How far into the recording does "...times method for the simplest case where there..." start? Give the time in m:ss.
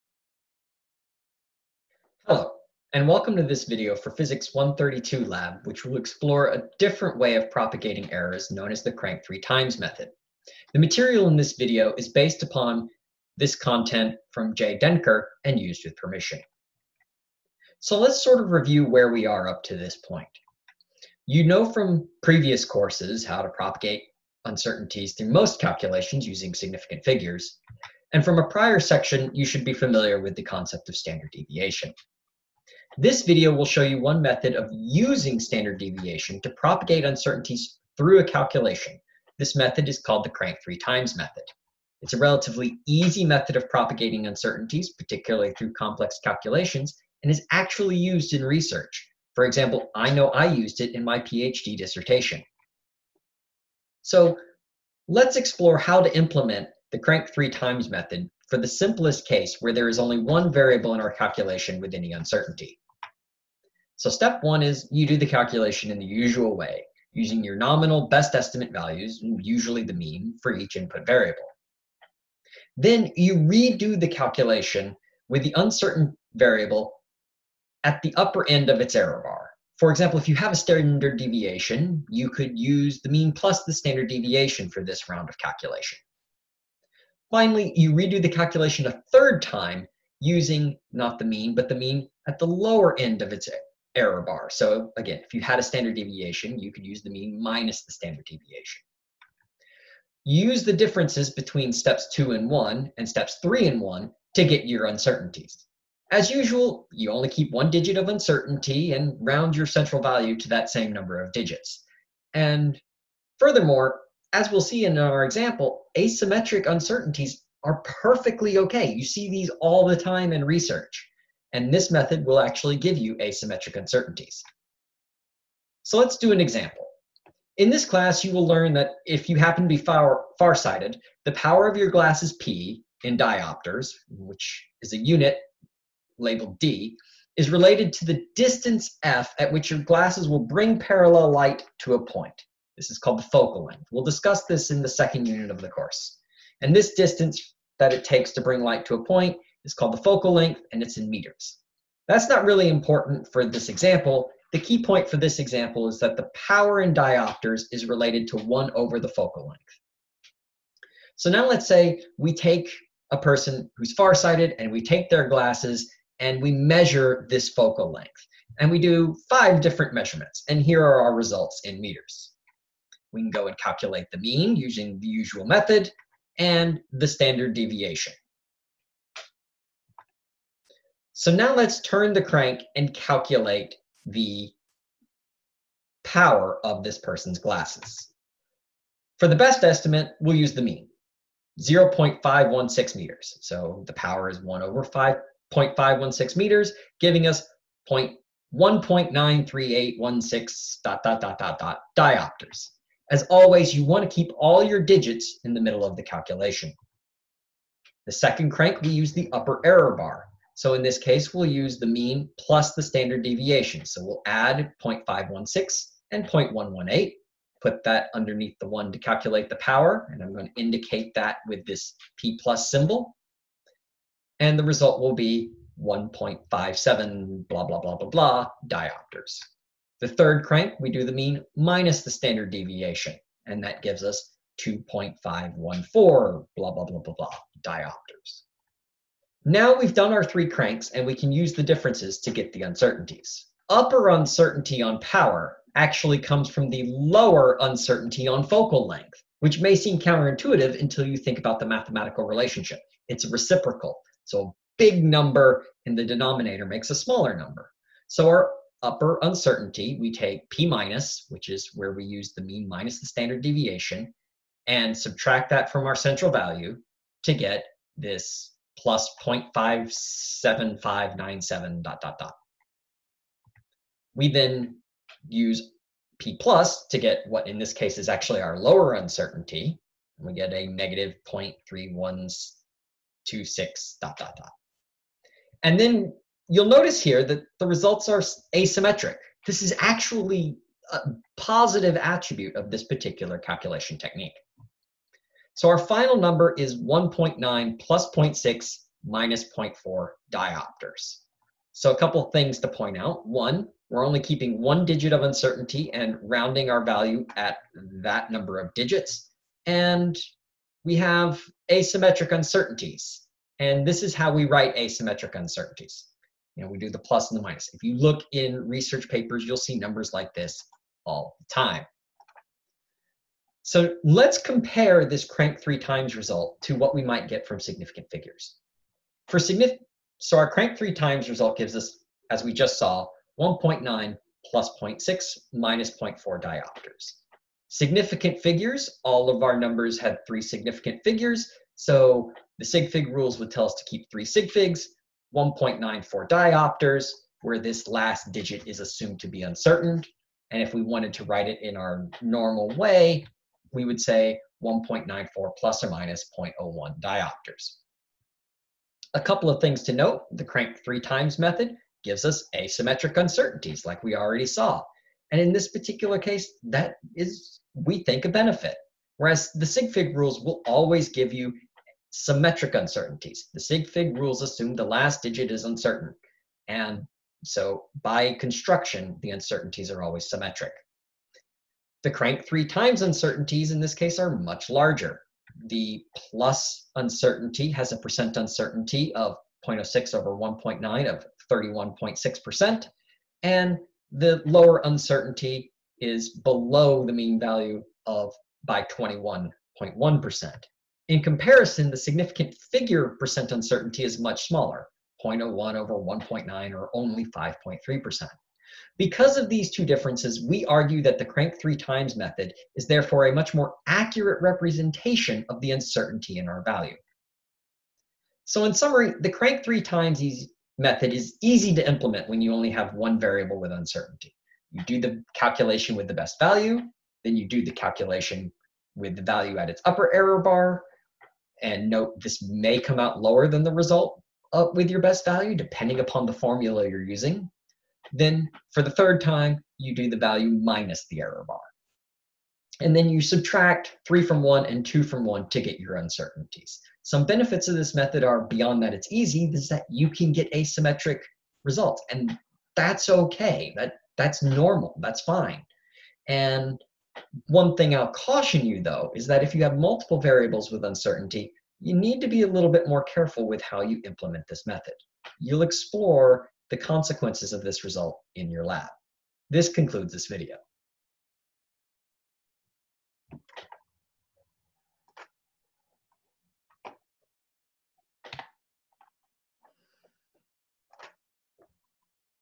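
0:57.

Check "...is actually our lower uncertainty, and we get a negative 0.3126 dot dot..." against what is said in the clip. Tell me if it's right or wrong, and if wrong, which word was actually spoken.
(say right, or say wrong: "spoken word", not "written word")
right.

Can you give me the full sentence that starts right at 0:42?
It's a relatively easy method of propagating uncertainties, particularly through complex calculations, and is actually used in research.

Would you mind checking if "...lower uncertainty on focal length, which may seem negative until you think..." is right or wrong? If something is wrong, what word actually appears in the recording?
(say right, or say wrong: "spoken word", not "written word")
wrong: "counterintuitive", not "negative".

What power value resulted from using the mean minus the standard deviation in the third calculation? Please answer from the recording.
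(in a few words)
2.514 diopters.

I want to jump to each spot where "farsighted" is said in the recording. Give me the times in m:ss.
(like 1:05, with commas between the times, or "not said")
2:10, 2:43.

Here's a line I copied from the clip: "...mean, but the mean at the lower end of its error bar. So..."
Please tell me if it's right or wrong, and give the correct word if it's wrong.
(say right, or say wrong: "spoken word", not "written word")
right.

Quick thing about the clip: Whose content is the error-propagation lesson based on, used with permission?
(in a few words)
Jay Denker.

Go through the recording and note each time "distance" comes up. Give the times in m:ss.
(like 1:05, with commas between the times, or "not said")
2:18, 2:26.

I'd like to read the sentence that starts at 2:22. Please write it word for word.
This is called the focal length.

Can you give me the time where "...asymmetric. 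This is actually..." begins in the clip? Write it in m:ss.
4:48.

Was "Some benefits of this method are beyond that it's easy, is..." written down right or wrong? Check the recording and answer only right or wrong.
right.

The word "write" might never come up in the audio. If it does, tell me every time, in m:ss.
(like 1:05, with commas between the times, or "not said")
5:14, 5:51.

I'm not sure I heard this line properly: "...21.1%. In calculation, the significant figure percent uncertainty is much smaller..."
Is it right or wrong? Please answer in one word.
wrong.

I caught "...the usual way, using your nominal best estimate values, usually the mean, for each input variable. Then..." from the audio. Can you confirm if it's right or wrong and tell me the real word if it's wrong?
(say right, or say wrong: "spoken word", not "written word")
right.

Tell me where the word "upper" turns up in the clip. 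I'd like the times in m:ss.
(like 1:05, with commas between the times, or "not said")
1:18, 3:29, 4:03, 4:18, 7:09.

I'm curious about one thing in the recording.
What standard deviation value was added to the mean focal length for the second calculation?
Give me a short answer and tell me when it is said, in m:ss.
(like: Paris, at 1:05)
0.118 meters, at 3:36.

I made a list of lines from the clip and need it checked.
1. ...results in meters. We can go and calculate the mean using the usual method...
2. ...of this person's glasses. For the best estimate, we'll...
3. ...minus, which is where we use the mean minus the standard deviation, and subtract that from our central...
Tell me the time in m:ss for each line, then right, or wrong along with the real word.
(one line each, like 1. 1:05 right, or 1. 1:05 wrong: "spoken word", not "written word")
1. 2:51 right
2. 3:06 right
3. 4:20 right.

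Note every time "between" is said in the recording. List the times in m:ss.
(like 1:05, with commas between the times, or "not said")
1:41.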